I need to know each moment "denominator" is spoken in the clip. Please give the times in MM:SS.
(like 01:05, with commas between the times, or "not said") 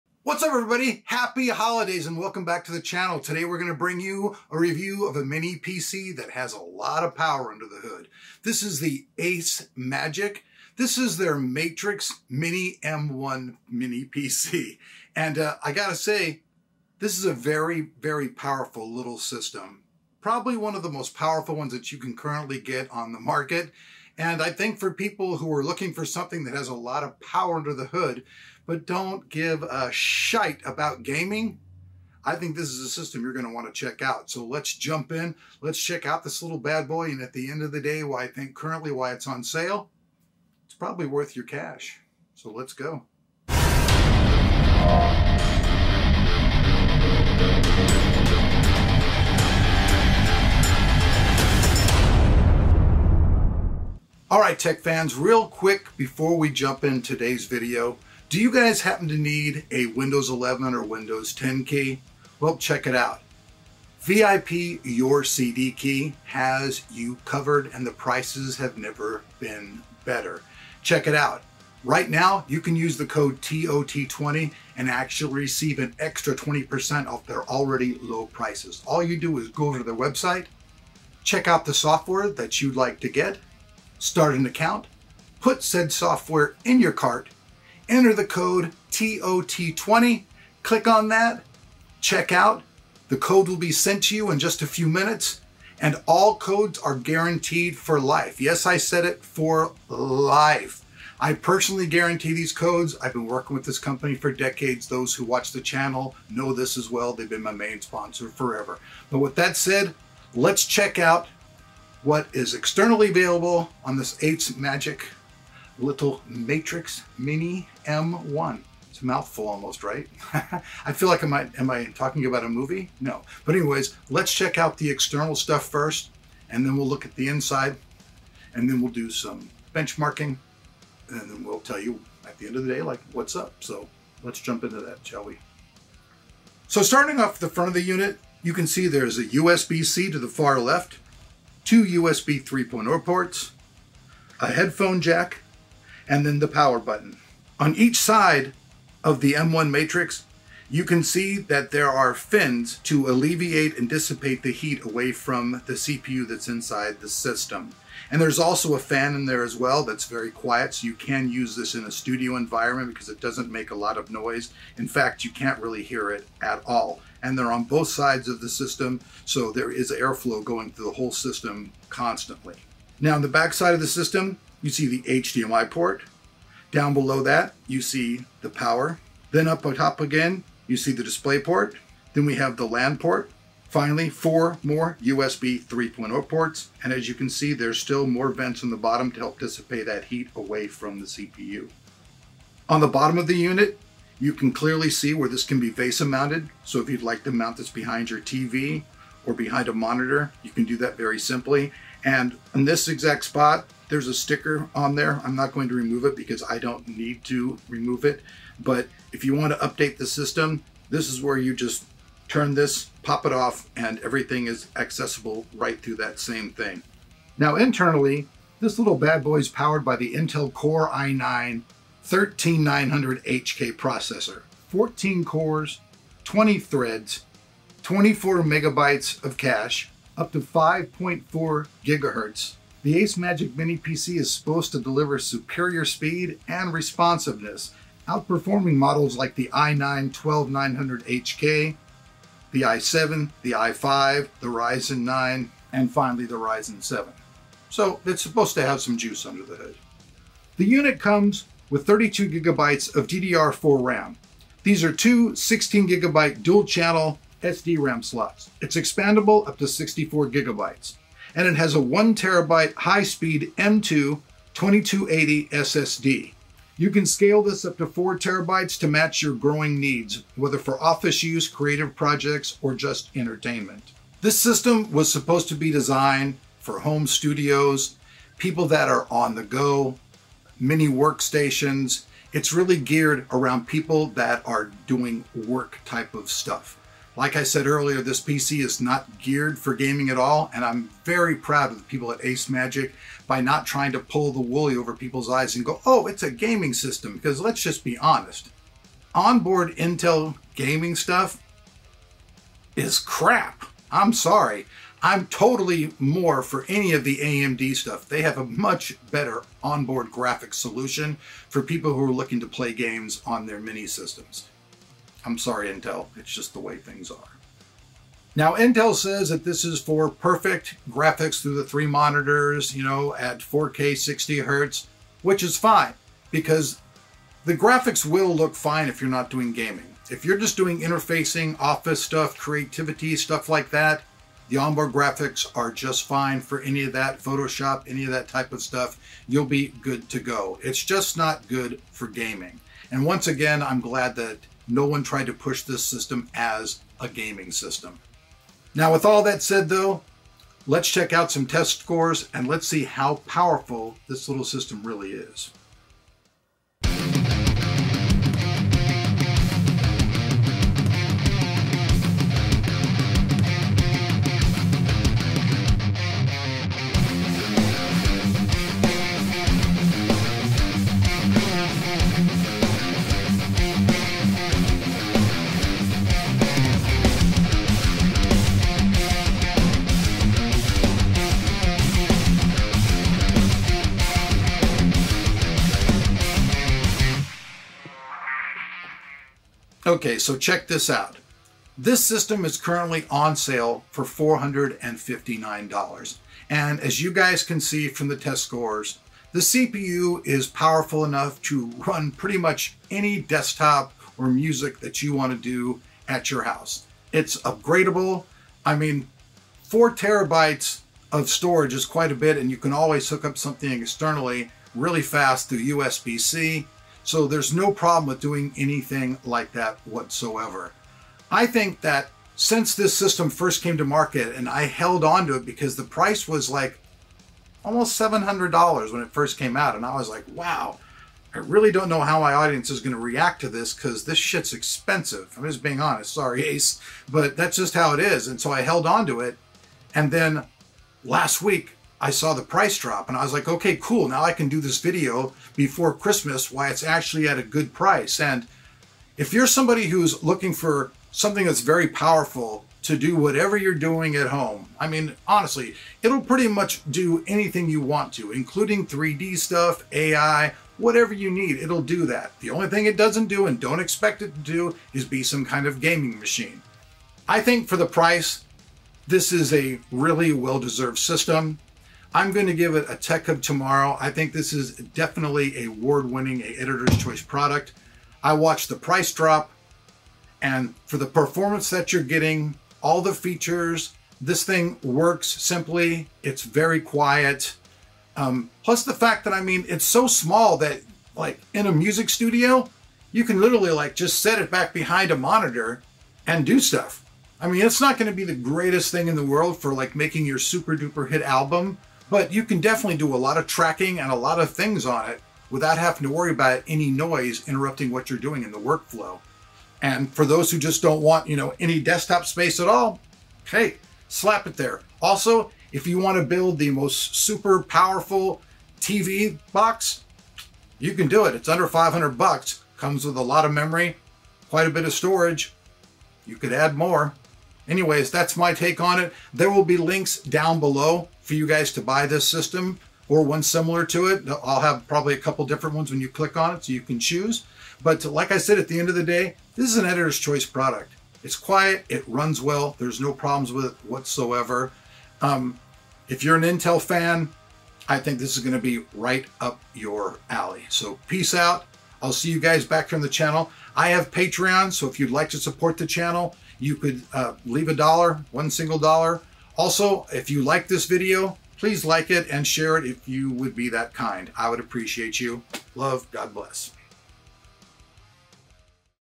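not said.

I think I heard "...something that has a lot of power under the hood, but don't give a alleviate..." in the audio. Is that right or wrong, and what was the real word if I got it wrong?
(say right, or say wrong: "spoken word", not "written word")
wrong: "shite", not "alleviate".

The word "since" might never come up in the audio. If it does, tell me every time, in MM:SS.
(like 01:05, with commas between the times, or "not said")
07:02.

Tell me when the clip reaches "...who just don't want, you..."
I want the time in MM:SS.
08:30.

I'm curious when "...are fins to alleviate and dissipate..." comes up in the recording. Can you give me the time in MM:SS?
02:31.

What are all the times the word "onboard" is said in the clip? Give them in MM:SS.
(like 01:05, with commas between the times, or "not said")
04:59, 05:09, 05:34.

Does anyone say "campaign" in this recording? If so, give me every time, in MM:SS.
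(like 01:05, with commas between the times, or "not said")
not said.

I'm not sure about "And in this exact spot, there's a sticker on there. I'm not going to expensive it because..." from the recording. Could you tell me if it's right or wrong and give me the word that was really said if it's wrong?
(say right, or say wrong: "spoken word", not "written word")
wrong: "remove", not "expensive".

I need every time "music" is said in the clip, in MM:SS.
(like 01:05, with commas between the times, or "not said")
06:44, 08:11.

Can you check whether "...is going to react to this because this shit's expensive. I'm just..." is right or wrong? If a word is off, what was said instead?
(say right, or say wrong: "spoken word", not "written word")
right.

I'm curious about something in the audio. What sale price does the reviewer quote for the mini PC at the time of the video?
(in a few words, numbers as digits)
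$459.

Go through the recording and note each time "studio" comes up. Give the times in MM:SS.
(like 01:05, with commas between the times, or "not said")
02:41, 04:37, 08:12.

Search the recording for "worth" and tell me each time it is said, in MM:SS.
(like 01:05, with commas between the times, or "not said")
00:41.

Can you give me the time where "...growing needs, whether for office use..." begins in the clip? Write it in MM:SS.
04:29.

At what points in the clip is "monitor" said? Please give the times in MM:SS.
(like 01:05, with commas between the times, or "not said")
03:19, 05:21, 08:15.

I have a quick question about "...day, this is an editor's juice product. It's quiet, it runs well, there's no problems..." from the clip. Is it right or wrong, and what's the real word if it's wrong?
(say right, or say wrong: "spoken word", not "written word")
wrong: "choice", not "juice".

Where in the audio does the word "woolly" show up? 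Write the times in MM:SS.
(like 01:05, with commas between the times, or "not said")
04:54.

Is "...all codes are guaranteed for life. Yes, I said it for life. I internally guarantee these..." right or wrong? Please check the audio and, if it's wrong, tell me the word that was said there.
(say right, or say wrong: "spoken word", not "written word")
wrong: "personally", not "internally".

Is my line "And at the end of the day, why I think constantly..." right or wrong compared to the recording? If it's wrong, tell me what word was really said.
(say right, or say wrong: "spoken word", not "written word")
wrong: "currently", not "constantly".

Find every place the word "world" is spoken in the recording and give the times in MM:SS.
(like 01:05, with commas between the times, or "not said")
08:19.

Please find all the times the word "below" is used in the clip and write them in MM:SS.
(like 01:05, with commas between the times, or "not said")
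02:56, 08:50.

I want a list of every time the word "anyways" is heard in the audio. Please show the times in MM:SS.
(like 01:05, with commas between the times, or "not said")
02:03, 08:47.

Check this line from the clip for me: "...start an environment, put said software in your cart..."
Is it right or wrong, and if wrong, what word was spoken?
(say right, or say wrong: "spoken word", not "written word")
wrong: "account", not "environment".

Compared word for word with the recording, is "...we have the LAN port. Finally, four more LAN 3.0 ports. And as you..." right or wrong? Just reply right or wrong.
wrong.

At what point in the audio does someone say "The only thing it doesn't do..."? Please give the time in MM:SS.
07:42.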